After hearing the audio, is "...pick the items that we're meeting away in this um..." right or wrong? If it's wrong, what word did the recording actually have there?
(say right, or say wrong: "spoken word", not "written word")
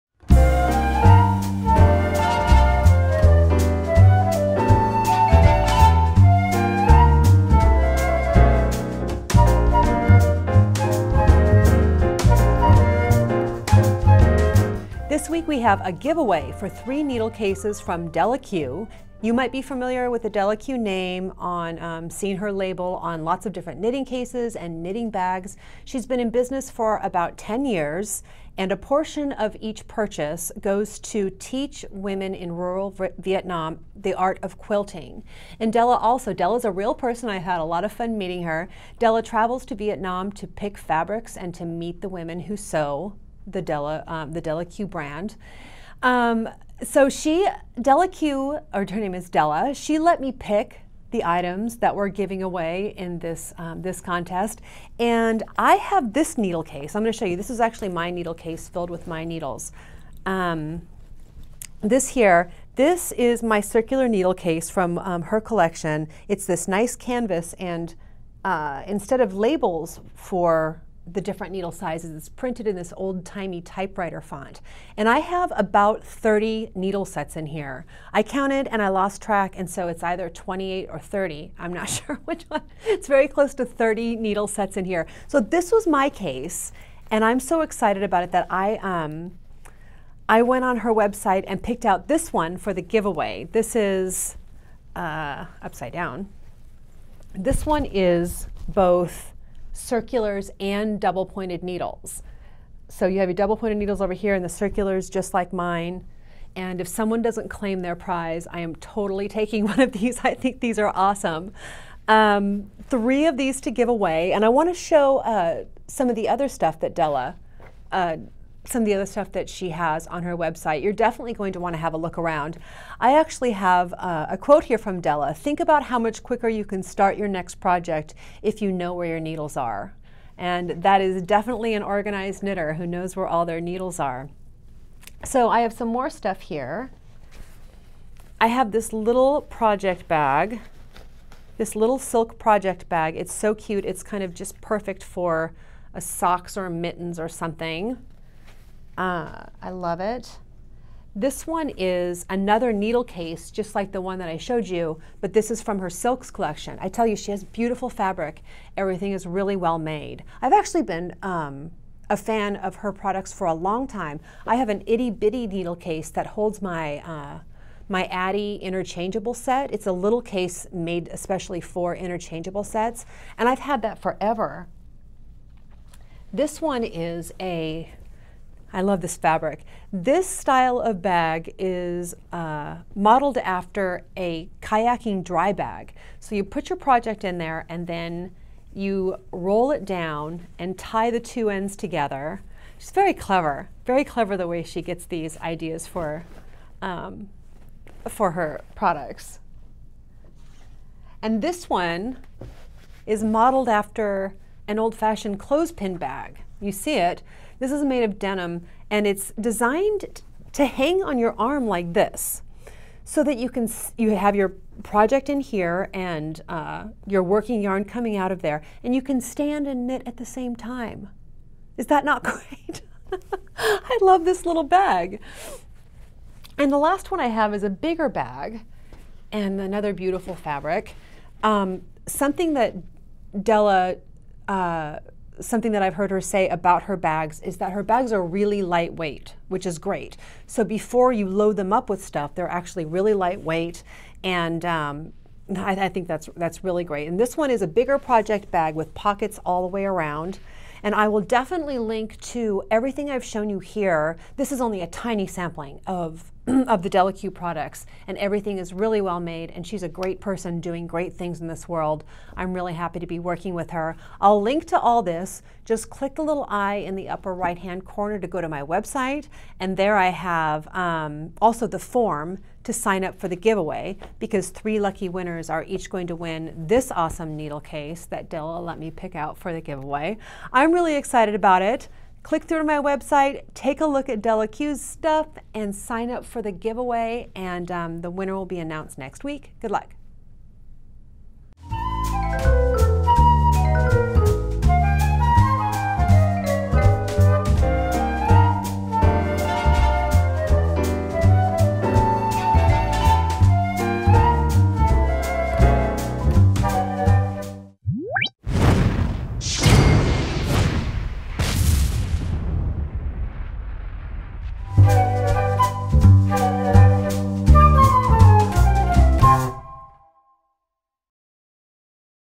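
wrong: "giving", not "meeting".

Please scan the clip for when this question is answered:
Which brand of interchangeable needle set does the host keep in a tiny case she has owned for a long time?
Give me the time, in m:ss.
2:48.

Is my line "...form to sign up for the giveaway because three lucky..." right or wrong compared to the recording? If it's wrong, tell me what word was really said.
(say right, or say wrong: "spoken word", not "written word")
right.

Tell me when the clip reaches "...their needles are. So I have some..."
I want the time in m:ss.
2:13.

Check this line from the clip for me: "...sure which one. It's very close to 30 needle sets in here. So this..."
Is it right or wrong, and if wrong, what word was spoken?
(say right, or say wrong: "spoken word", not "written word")
right.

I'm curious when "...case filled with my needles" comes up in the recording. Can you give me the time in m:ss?
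0:58.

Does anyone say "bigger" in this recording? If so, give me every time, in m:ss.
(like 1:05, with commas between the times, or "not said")
3:47, 4:07.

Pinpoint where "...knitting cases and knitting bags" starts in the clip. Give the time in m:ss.
0:23.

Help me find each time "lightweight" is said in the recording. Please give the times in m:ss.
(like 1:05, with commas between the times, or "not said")
3:58, 4:03.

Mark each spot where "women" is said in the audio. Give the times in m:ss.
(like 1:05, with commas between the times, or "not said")
0:31, 0:42.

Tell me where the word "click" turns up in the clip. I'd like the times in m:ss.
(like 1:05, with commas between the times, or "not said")
4:25, 4:42.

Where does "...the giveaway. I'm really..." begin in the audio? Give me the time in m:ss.
4:39.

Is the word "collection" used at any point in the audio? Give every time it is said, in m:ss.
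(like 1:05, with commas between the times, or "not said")
1:05, 2:36.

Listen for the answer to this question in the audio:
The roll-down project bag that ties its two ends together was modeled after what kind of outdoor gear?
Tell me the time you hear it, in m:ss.
3:04.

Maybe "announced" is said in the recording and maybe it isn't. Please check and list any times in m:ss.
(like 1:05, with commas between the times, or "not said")
4:48.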